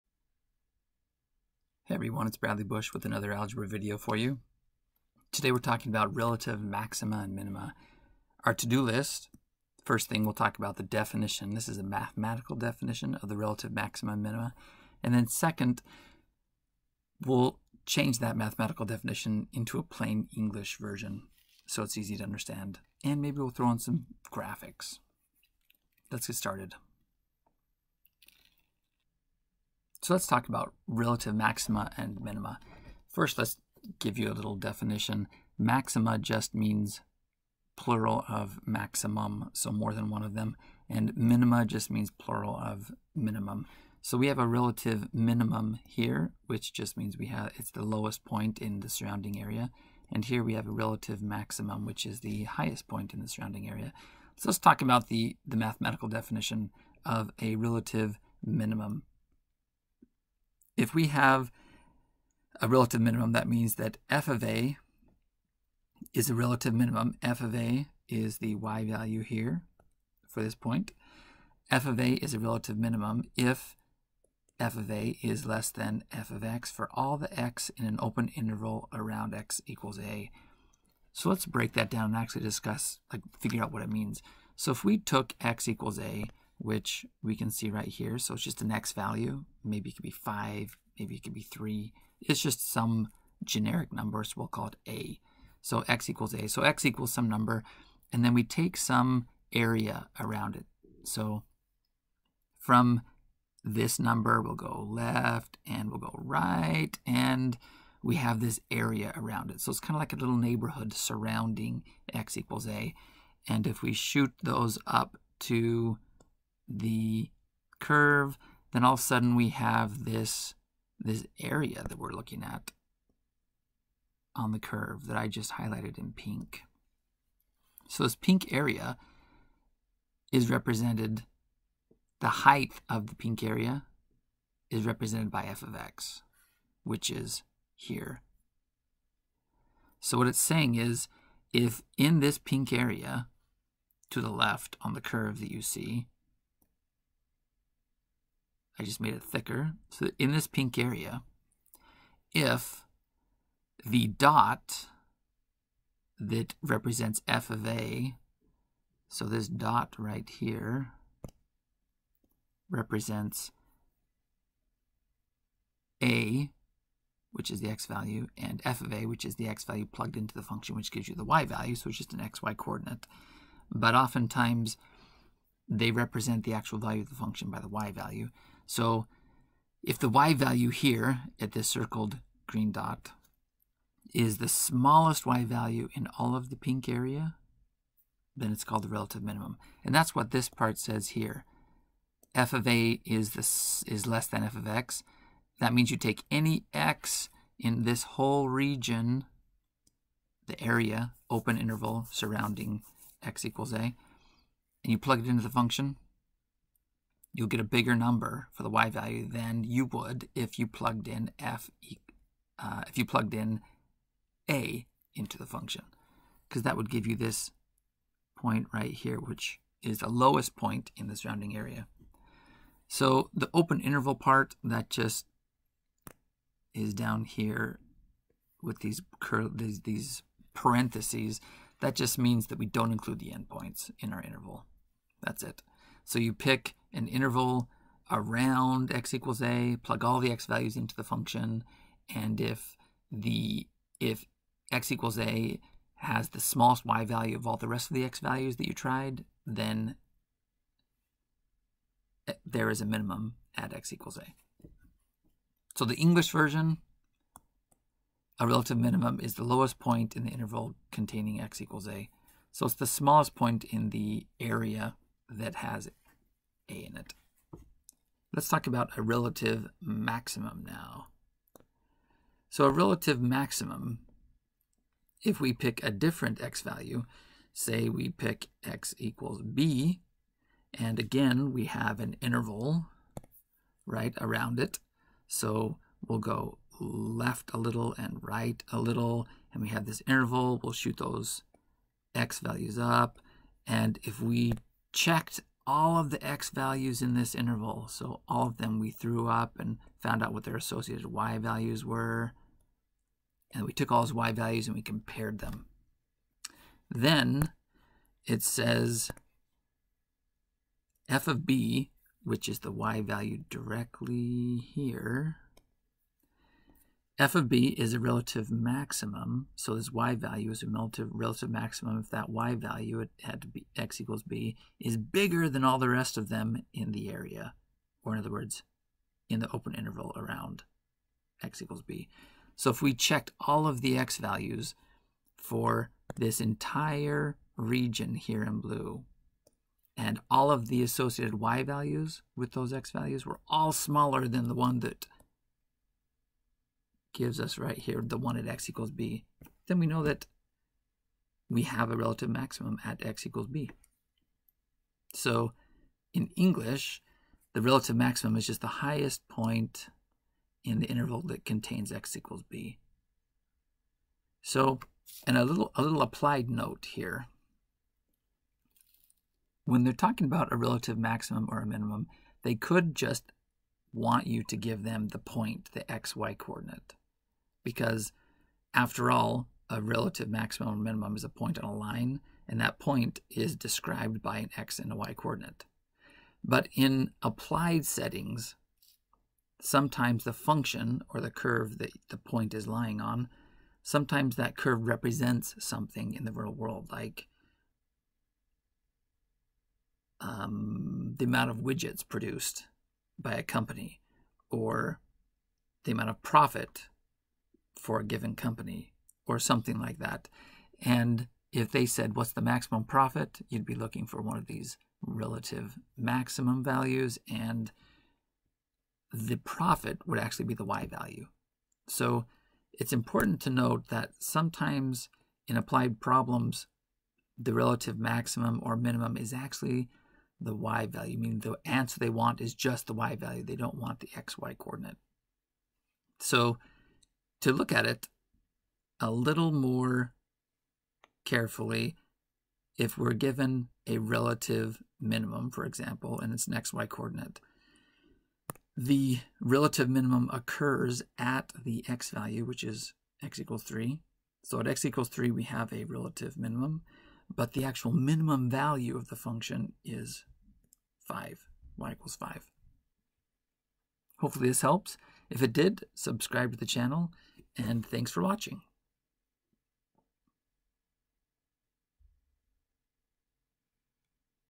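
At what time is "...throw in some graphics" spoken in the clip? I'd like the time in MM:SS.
00:23.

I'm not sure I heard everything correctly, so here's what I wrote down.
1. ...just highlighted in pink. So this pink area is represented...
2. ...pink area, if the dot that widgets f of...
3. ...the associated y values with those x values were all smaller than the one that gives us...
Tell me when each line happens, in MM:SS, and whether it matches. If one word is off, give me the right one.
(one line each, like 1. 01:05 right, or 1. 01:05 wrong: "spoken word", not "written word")
1. 02:05 right
2. 02:30 wrong: "represents", not "widgets"
3. 05:40 right.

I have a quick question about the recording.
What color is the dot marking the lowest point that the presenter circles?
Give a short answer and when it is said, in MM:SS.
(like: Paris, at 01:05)
green, at 03:02.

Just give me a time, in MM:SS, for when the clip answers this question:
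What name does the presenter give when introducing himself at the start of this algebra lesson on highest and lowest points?
00:02.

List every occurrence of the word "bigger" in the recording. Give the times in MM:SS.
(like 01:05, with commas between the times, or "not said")
03:27, 05:24.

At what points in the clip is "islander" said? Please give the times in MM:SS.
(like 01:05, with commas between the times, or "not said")
not said.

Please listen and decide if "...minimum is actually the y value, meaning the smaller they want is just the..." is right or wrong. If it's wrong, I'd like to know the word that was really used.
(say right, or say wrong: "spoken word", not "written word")
wrong: "answer", not "smaller".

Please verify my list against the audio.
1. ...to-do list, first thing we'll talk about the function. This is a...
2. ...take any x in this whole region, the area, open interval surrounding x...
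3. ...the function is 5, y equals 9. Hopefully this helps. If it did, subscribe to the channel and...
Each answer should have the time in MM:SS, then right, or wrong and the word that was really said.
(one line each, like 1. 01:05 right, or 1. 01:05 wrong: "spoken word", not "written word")
1. 00:08 wrong: "definition", not "function"
2. 03:15 right
3. 07:39 wrong: "5", not "9".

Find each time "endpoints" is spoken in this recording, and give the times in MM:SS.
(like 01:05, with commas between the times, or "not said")
03:53.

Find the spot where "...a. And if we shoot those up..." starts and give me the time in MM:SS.
01:52.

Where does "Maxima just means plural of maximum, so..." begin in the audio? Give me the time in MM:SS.
00:35.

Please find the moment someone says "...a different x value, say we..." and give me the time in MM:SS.
04:35.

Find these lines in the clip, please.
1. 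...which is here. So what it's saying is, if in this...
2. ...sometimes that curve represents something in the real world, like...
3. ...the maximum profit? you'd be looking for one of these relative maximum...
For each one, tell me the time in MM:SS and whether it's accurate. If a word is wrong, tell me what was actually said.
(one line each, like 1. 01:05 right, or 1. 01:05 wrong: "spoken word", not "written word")
1. 02:16 right
2. 06:33 right
3. 06:52 right.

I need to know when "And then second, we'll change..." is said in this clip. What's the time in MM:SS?
00:15.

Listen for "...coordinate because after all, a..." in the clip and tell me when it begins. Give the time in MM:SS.
06:16.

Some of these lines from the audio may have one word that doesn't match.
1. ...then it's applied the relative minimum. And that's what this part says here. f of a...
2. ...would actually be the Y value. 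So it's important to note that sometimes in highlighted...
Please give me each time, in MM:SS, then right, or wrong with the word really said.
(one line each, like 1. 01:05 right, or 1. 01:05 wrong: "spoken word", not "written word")
1. 03:08 wrong: "called", not "applied"
2. 07:00 wrong: "applied", not "highlighted".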